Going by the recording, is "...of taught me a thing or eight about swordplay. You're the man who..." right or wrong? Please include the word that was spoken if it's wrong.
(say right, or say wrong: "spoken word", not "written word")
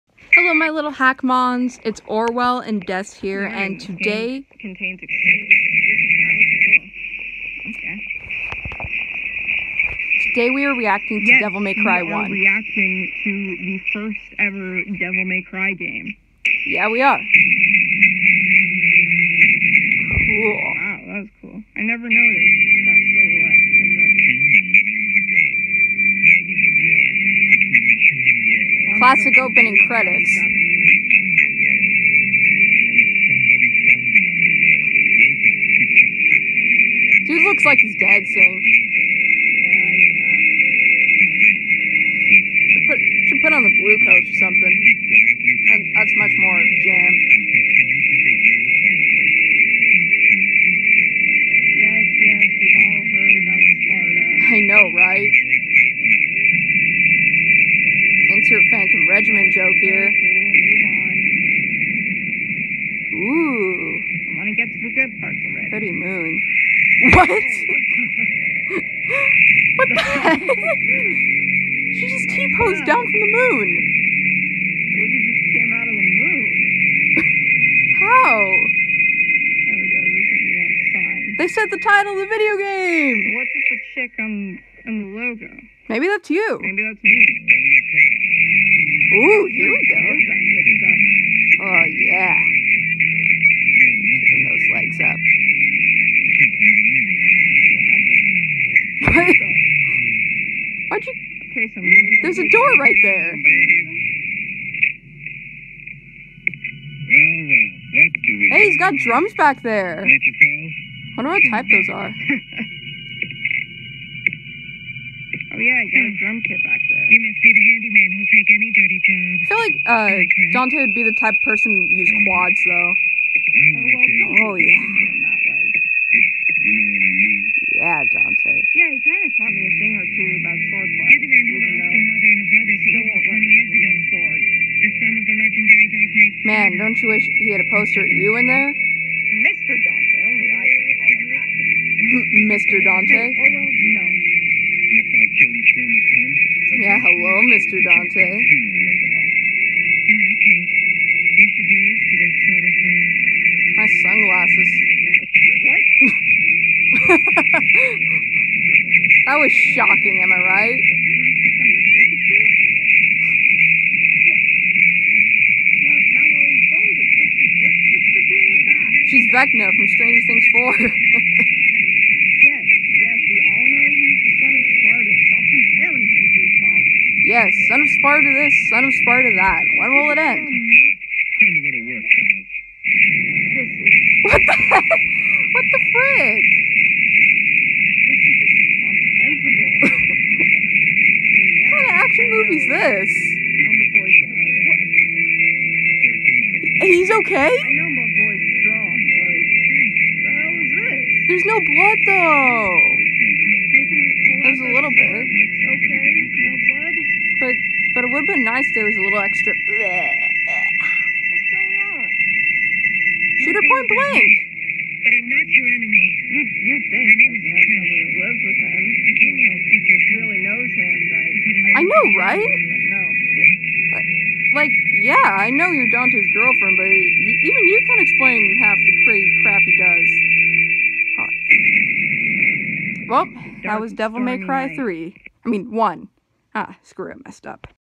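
wrong: "two", not "eight".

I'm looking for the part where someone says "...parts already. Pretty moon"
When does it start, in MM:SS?
01:05.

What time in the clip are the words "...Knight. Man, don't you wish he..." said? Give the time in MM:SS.
02:16.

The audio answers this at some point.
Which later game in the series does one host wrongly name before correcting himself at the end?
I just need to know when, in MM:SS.
03:53.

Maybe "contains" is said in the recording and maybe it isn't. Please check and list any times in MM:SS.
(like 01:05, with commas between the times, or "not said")
00:04.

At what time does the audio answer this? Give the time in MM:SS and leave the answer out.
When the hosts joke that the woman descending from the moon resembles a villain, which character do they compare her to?
02:49.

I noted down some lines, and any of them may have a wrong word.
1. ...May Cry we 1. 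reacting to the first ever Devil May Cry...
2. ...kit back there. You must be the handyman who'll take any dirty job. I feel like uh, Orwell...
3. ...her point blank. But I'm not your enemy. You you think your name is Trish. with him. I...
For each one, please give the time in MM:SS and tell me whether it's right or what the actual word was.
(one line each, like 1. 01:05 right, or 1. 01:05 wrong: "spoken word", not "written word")
1. 00:11 right
2. 01:56 wrong: "John", not "Orwell"
3. 03:33 right.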